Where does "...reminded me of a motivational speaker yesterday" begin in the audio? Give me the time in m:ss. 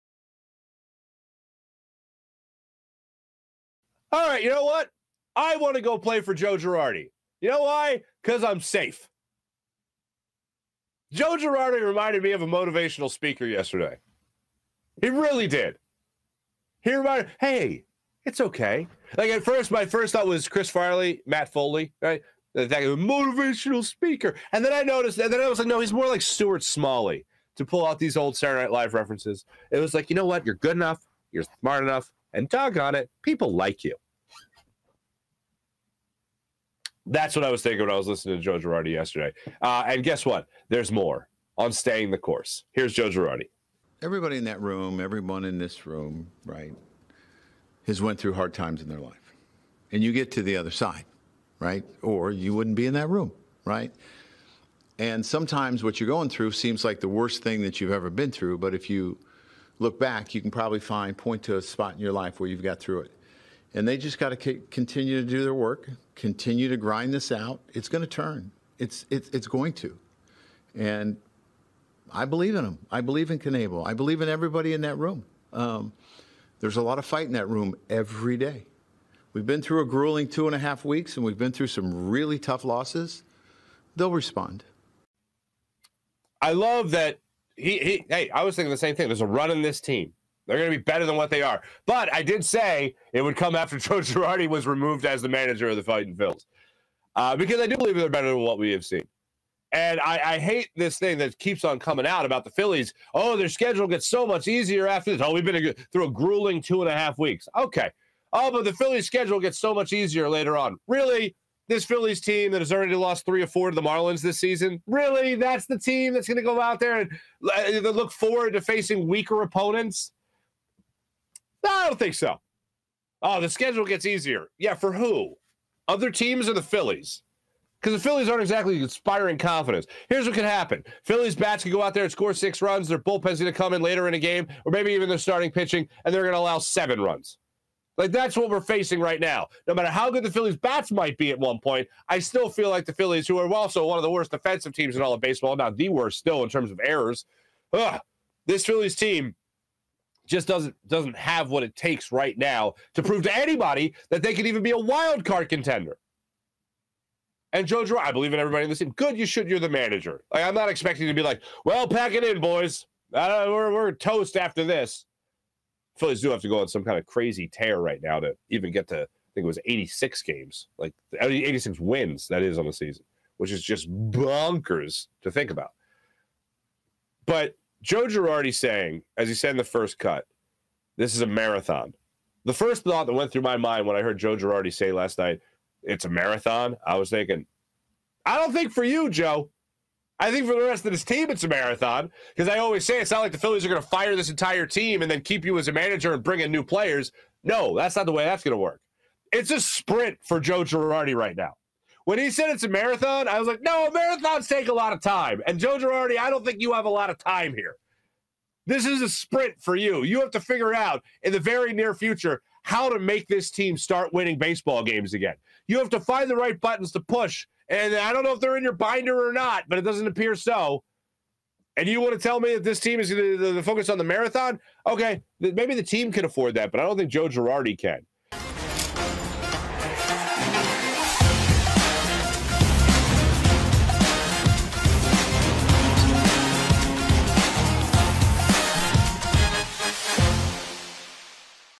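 0:11.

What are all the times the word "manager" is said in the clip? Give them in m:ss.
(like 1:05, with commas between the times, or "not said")
1:35, 2:39, 3:15.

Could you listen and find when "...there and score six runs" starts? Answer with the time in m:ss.
2:11.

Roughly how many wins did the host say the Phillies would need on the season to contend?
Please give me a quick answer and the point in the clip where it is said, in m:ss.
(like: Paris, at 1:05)
86, at 2:51.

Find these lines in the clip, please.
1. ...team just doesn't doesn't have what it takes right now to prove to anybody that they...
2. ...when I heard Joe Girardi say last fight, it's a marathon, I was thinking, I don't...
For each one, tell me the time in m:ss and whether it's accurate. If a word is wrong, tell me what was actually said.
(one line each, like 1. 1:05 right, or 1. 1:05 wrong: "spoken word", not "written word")
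1. 2:28 right
2. 3:03 wrong: "night", not "fight".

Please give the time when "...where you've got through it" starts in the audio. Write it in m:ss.
1:02.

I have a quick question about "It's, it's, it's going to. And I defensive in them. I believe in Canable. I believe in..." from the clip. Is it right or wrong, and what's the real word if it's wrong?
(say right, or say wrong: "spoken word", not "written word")
wrong: "believe", not "defensive".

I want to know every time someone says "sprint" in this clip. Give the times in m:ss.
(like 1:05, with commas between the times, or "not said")
3:19, 3:29.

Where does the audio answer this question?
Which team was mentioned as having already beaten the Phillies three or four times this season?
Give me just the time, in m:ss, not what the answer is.
1:53.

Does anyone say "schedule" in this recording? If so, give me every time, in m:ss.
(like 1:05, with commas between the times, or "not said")
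1:43, 1:49, 2:03.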